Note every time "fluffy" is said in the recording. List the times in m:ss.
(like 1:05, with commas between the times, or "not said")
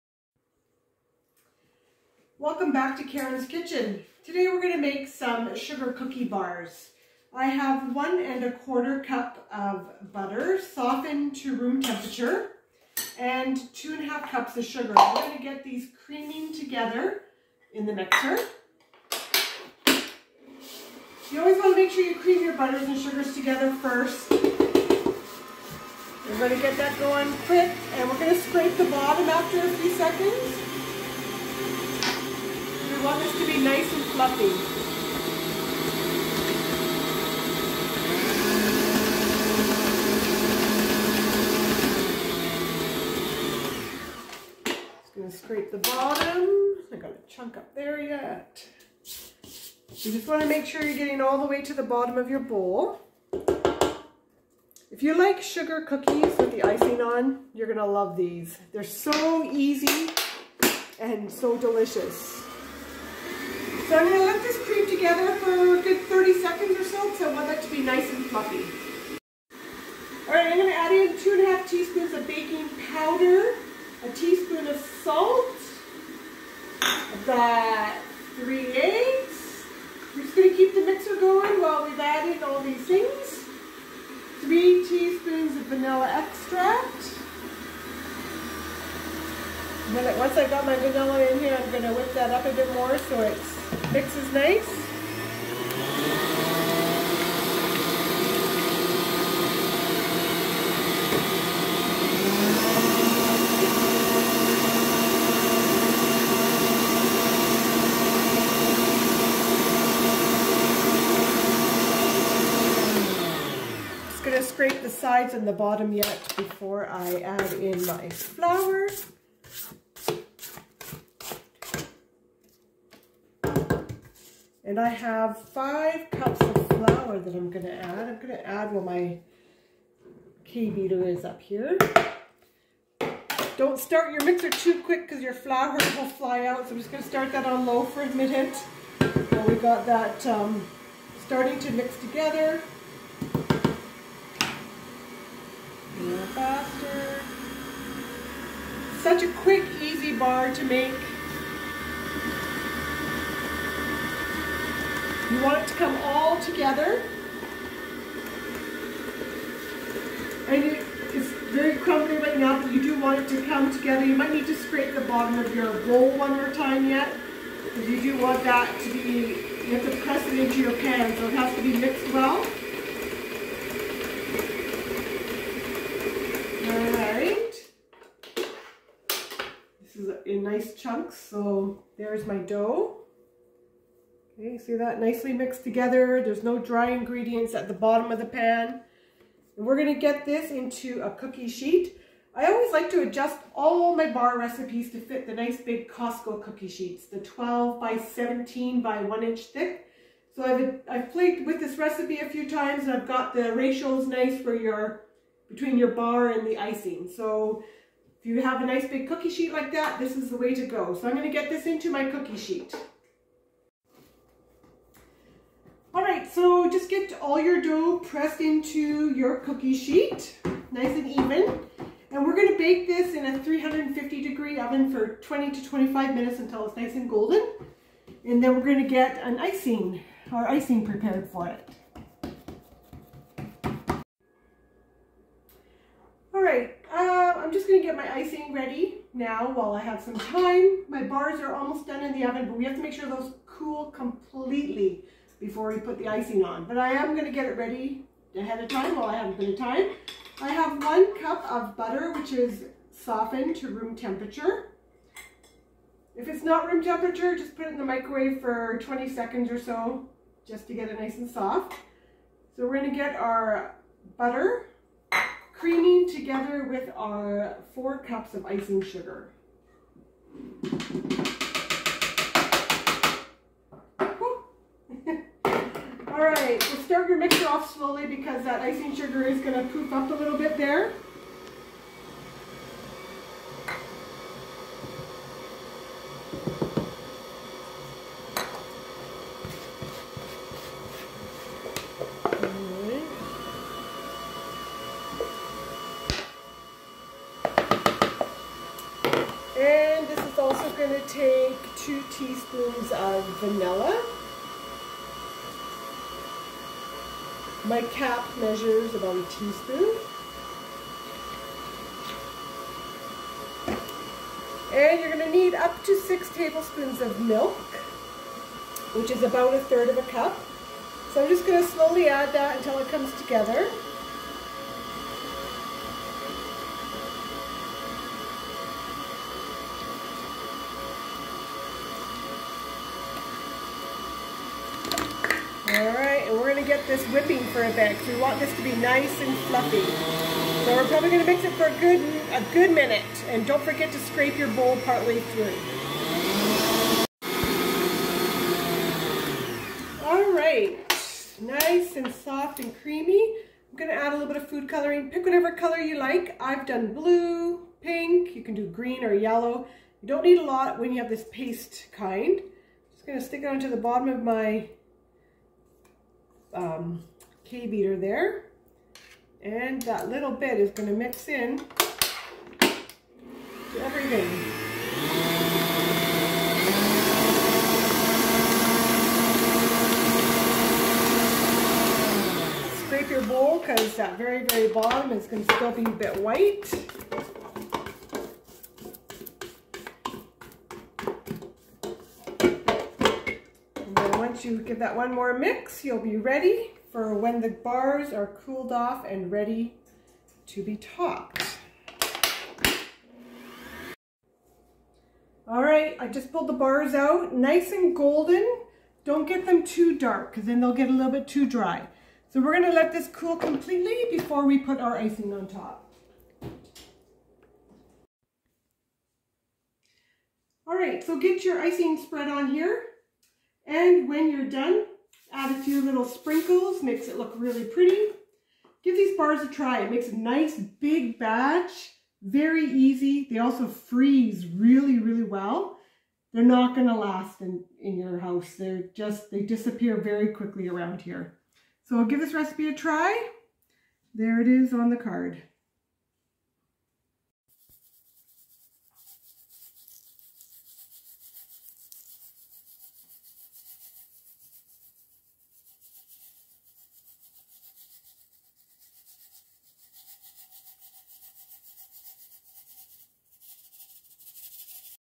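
0:34, 1:08, 5:39.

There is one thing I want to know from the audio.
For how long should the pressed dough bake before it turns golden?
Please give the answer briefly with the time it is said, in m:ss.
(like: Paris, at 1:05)
20 to 25 minutes, at 3:45.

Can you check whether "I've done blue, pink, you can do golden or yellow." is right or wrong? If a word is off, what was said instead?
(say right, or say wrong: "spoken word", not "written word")
wrong: "green", not "golden".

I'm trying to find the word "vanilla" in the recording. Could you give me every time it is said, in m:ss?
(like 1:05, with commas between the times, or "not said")
1:25, 1:30, 5:03.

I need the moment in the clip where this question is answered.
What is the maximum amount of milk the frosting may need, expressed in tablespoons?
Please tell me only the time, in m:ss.
5:15.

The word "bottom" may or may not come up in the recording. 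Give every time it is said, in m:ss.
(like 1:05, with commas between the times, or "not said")
0:28, 0:45, 0:51, 1:55, 2:44, 3:07, 6:03, 6:24.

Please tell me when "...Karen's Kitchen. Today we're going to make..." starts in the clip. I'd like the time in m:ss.
0:03.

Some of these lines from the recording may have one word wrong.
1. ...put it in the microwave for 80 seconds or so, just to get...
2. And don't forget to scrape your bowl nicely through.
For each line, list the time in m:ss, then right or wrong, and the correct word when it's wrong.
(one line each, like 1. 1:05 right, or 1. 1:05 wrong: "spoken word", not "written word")
1. 4:17 wrong: "20", not "80"
2. 5:43 wrong: "partly", not "nicely".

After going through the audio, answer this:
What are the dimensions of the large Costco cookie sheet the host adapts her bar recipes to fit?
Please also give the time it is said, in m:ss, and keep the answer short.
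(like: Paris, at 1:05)
12 by 17, at 3:17.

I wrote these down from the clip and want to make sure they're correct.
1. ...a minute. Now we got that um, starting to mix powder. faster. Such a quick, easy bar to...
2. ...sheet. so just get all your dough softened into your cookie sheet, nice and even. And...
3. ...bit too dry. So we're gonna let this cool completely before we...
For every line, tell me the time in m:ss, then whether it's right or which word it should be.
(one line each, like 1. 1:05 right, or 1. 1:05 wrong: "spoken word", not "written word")
1. 2:18 wrong: "together", not "powder"
2. 3:32 wrong: "pressed", not "softened"
3. 6:51 right.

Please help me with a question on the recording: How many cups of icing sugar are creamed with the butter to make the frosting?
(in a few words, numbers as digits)
4 cups.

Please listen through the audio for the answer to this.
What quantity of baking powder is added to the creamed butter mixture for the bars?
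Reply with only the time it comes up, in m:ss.
1:11.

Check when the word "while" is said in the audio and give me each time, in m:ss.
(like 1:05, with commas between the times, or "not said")
1:21, 3:59.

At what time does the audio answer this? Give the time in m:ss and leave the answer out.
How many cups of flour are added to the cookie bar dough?
2:05.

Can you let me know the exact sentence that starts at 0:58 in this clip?
They're so easy and so delicious.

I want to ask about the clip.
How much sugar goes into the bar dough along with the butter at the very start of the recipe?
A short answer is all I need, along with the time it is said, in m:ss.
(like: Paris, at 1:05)
2 1/2 cups, at 0:13.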